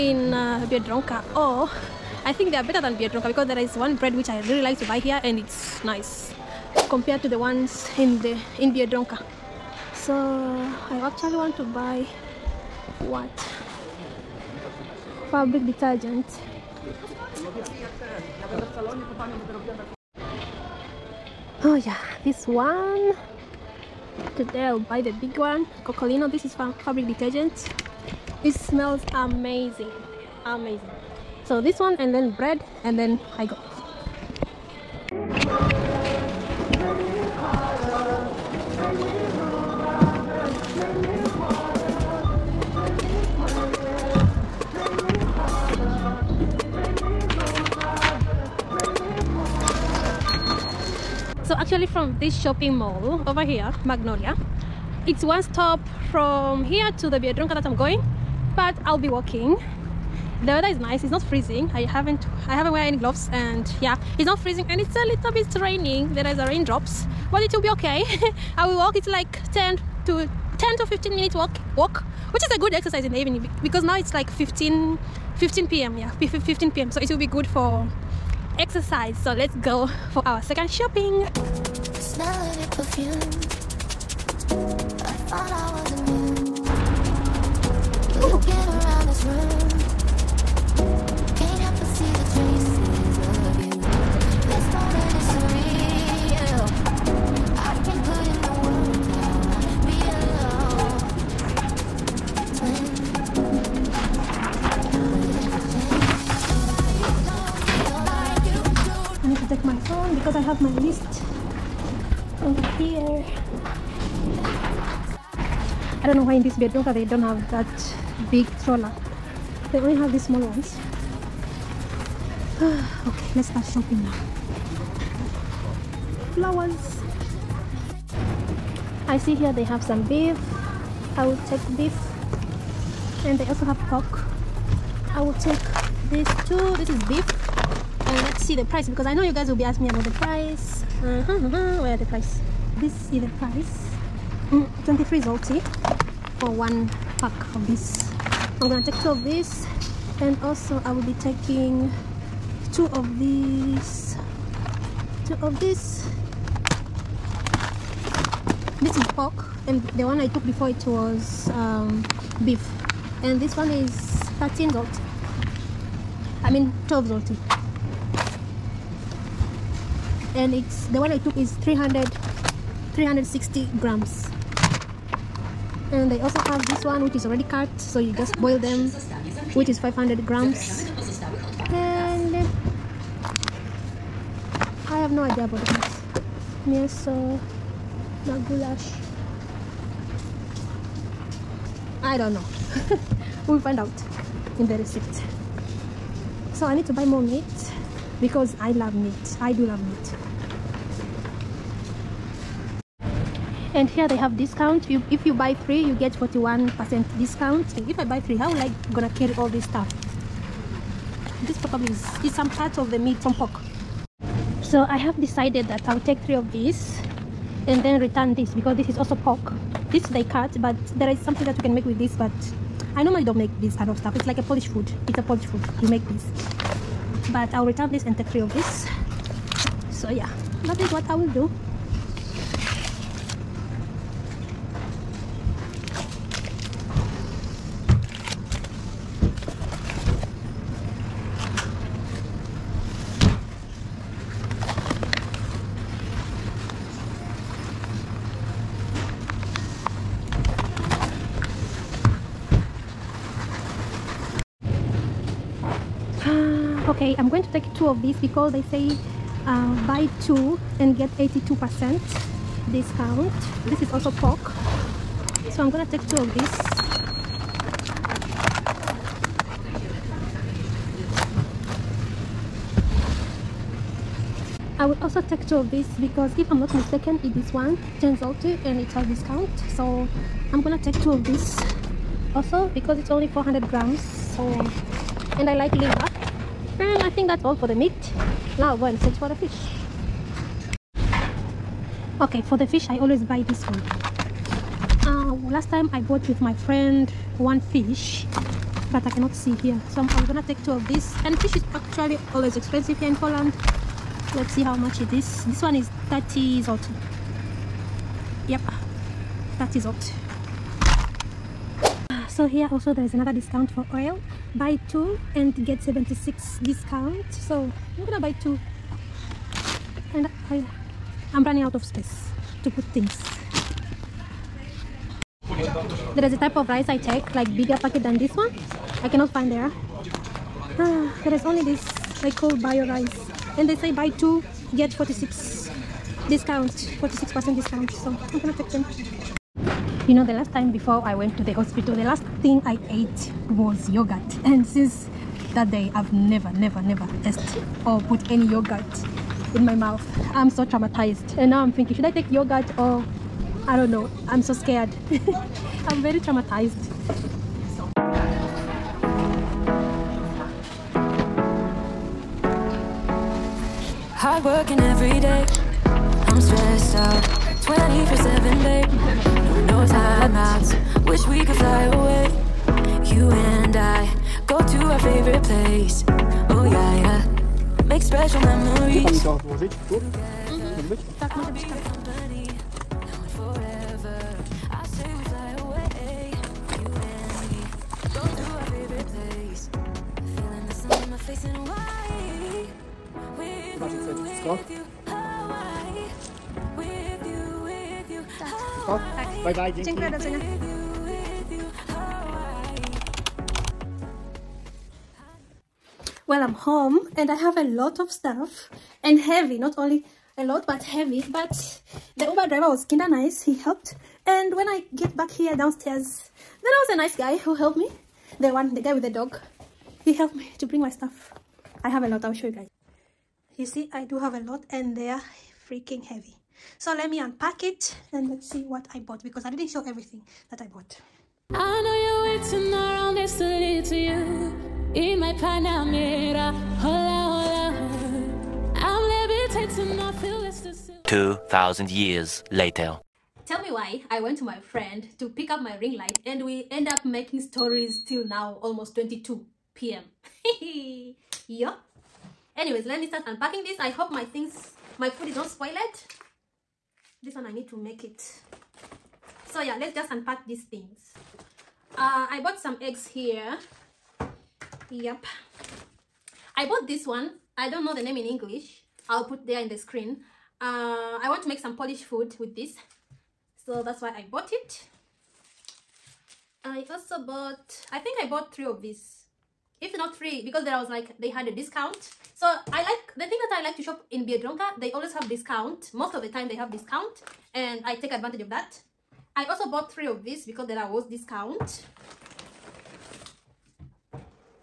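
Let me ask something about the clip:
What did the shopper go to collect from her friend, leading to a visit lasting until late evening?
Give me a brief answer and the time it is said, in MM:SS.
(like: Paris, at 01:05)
ring light, at 07:25.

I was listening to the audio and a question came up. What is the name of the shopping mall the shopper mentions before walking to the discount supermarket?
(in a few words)
Magnolia.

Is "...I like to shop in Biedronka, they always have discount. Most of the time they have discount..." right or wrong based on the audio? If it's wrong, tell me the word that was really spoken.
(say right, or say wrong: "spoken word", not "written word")
right.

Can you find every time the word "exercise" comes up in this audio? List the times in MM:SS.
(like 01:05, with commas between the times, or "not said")
01:12, 01:18.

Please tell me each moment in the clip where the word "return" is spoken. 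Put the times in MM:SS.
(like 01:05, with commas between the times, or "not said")
03:37, 03:47.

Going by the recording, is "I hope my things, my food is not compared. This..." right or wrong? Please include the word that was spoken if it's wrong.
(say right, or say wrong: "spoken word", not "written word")
wrong: "spoiled", not "compared".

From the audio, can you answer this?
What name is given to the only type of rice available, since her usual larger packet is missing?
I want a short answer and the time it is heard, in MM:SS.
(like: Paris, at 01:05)
bio rice, at 05:32.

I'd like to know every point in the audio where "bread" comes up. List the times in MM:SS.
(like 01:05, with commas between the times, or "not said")
00:03, 00:32.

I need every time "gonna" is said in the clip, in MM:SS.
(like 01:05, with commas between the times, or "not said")
02:28, 03:28, 04:25, 04:40, 05:00, 05:18, 05:38.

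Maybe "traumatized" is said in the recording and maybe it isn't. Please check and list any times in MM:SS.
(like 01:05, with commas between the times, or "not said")
05:50, 05:56.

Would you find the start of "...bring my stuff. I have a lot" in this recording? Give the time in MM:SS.
07:00.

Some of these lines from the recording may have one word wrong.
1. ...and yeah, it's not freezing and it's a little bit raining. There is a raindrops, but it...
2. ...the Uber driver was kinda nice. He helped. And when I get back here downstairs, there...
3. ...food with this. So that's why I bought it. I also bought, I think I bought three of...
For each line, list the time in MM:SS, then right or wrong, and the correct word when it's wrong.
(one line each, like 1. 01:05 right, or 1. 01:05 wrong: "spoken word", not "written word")
1. 01:03 right
2. 06:52 right
3. 07:52 right.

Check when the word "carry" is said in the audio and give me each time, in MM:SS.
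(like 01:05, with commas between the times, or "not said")
03:29.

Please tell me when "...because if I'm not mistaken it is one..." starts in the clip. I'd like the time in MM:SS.
04:36.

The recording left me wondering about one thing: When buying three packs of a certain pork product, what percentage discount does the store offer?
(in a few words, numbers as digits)
41%.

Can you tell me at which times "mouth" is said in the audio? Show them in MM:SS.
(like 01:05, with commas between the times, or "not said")
05:49.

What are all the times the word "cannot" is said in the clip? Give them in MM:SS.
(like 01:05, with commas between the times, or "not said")
04:59, 05:29.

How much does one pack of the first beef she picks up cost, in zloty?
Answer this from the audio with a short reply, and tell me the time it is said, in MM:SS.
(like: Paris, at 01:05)
23 zloty, at 02:24.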